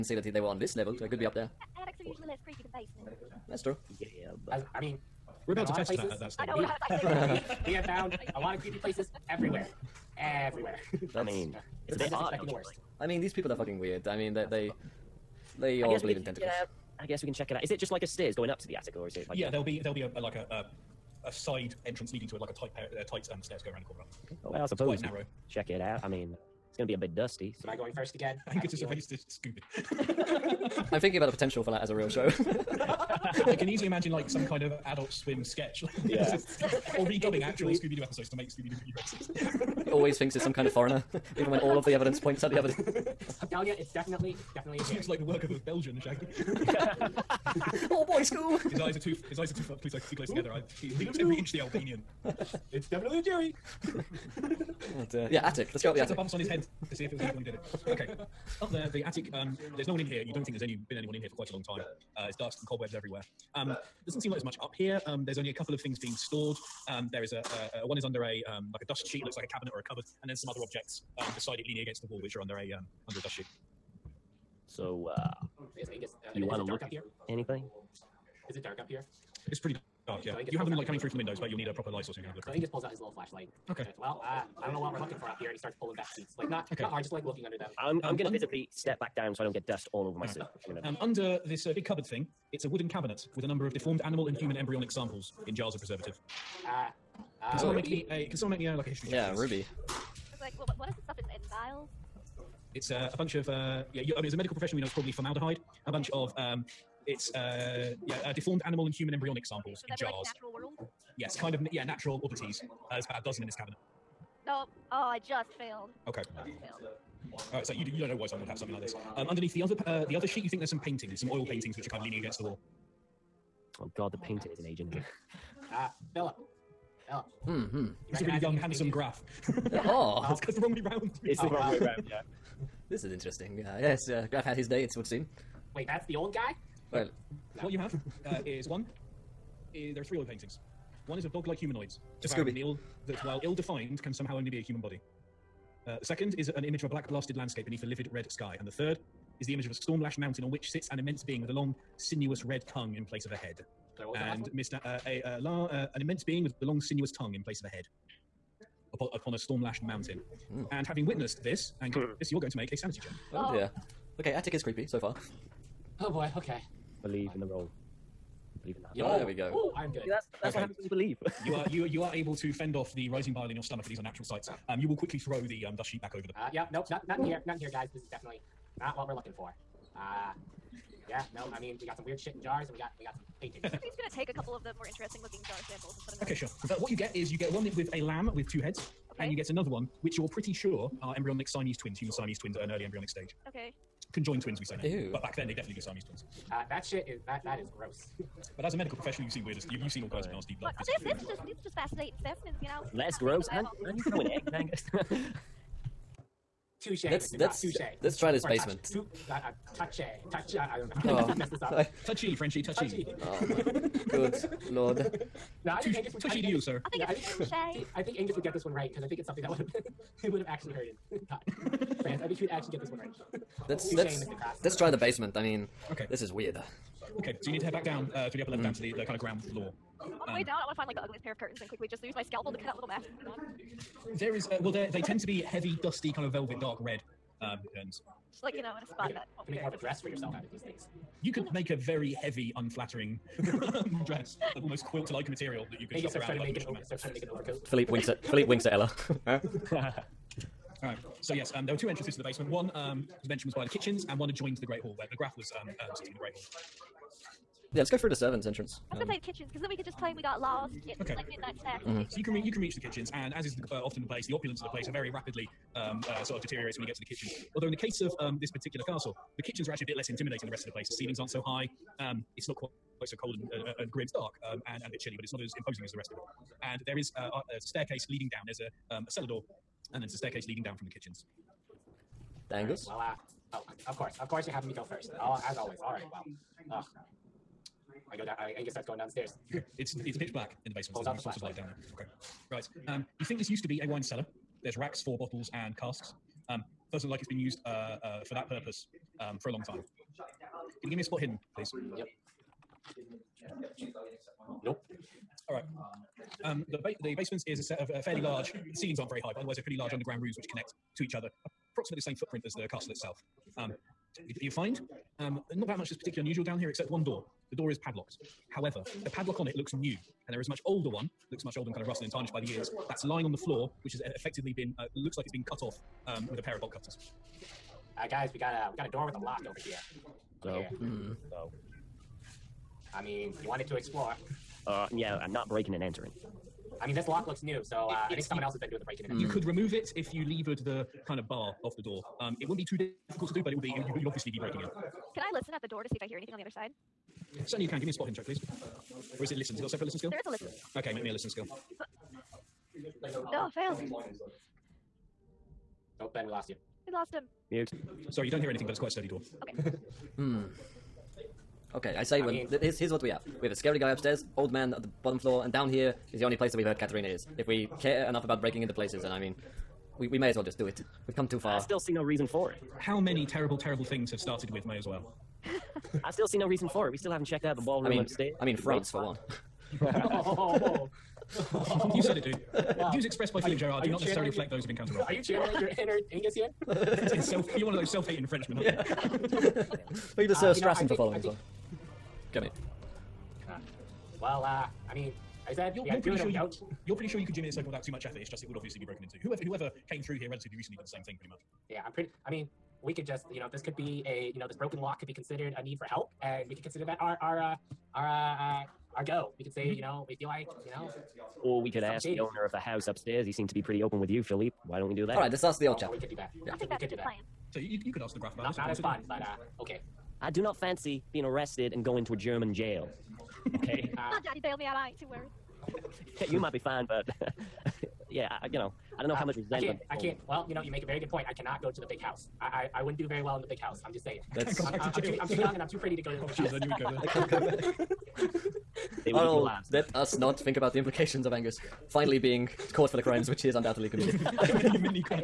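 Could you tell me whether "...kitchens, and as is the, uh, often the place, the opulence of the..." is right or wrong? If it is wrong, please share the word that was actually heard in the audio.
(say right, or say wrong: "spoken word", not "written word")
right.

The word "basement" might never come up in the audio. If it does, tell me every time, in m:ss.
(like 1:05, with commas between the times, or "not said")
0:02, 3:28, 3:44, 4:12, 4:50.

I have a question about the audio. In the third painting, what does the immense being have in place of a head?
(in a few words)
a long, sinuous red tongue.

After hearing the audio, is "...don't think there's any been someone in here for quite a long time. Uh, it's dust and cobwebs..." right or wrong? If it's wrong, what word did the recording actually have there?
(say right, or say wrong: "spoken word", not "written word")
wrong: "anyone", not "someone".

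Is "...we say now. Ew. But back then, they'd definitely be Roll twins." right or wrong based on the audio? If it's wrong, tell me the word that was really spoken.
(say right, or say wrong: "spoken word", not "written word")
wrong: "Siamese", not "Roll".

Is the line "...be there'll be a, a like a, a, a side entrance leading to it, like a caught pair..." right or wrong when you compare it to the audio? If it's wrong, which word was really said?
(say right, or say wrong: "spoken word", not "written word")
wrong: "tight", not "caught".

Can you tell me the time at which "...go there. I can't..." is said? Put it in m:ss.
7:16.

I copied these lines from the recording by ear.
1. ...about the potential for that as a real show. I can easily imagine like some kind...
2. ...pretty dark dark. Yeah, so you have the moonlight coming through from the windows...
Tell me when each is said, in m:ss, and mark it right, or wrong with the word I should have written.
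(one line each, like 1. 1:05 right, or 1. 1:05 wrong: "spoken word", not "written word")
1. 0:31 right
2. 1:19 right.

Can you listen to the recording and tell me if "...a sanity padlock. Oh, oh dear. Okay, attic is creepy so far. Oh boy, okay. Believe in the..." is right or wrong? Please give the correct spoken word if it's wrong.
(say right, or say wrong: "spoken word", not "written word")
wrong: "check", not "padlock".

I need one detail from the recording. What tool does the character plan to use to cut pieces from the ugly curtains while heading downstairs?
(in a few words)
scalpel.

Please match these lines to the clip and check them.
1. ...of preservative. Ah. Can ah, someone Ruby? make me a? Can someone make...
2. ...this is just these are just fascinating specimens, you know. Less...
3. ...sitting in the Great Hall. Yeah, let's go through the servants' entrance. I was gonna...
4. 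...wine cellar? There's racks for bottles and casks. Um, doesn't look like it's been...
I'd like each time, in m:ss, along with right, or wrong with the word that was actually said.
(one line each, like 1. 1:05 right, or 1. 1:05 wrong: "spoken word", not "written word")
1. 1:35 right
2. 3:21 right
3. 4:15 right
4. 4:53 right.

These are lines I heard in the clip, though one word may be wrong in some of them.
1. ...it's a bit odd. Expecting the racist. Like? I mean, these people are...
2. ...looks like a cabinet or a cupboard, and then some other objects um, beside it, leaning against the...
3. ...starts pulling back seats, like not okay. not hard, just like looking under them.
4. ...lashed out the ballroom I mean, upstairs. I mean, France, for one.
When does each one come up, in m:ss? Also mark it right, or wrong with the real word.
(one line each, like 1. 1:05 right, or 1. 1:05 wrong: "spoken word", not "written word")
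1. 0:11 wrong: "worst", not "racist"
2. 1:09 right
3. 1:25 right
4. 6:17 wrong: "checked", not "lashed".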